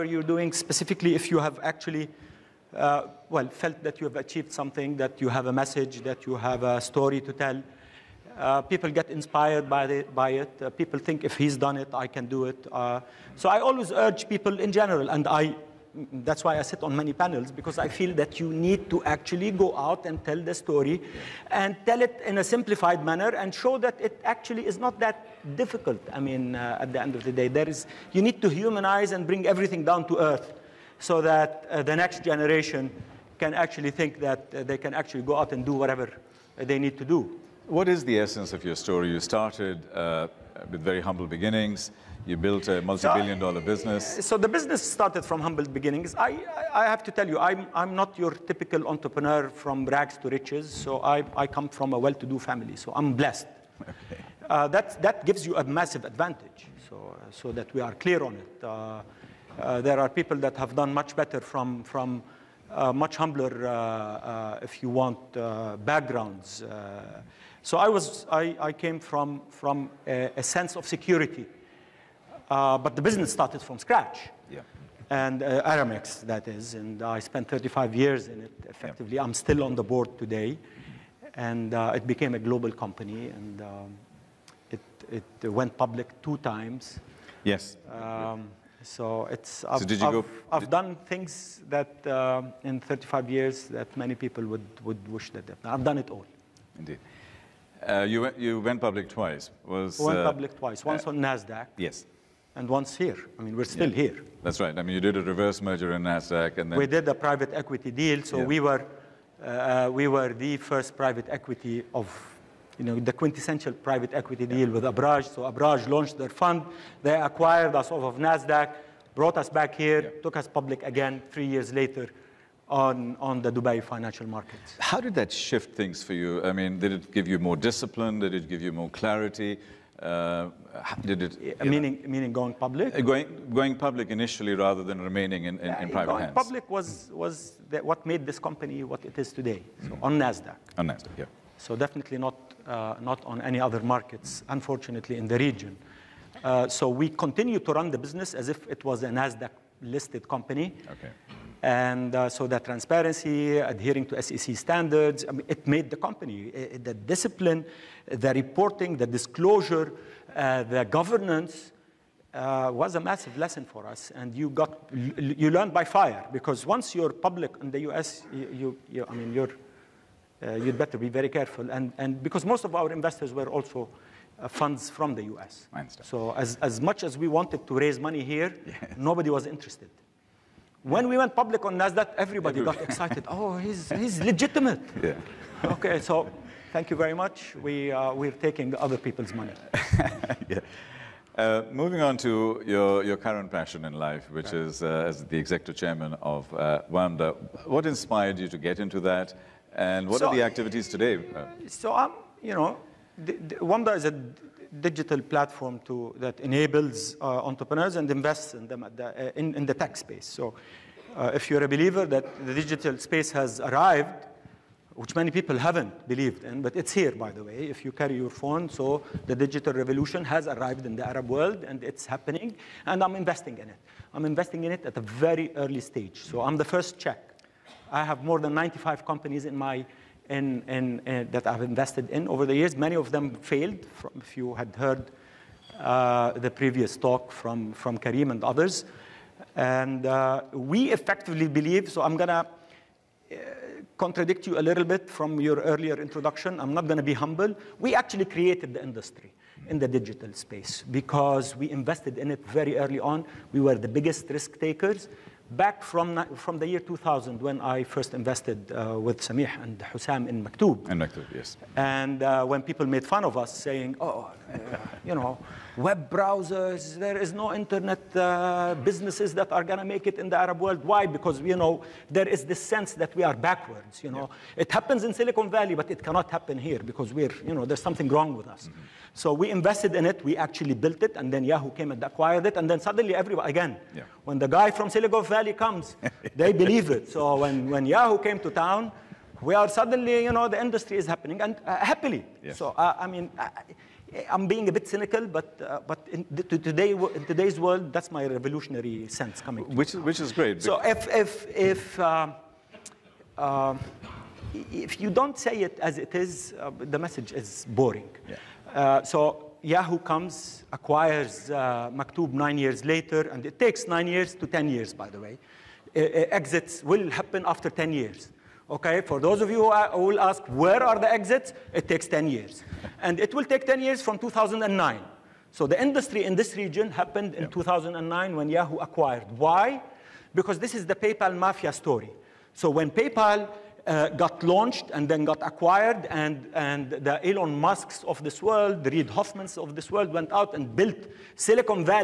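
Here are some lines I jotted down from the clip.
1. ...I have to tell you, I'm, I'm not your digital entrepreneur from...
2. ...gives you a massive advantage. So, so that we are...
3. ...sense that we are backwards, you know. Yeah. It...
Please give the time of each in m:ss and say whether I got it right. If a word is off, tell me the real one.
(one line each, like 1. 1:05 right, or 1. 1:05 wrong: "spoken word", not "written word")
1. 0:46 wrong: "typical", not "digital"
2. 0:55 right
3. 4:32 right.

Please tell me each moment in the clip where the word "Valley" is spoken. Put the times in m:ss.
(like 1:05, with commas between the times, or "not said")
4:35, 4:45.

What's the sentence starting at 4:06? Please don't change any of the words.
I'm not going to be humble.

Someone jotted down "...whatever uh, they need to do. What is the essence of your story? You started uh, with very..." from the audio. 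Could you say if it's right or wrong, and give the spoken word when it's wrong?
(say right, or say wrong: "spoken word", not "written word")
right.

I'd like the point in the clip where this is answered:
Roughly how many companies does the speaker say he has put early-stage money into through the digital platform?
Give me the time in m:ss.
3:48.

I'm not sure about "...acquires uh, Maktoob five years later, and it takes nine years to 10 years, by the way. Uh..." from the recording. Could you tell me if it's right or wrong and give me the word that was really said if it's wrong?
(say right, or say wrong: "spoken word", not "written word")
wrong: "nine", not "five".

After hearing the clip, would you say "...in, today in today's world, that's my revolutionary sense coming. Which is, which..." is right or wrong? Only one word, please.
right.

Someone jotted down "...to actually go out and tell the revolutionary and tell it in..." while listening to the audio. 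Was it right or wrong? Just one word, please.
wrong.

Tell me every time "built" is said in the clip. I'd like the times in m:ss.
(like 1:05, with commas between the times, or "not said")
0:42, 4:40, 5:40.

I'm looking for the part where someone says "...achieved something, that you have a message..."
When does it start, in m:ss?
0:04.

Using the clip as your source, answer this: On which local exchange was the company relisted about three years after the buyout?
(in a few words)
Dubai financial markets.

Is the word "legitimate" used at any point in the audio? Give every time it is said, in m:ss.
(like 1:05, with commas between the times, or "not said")
3:04.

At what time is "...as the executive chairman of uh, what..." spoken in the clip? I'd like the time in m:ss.
3:15.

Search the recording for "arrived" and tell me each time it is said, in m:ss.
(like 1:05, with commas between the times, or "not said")
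3:33, 3:40.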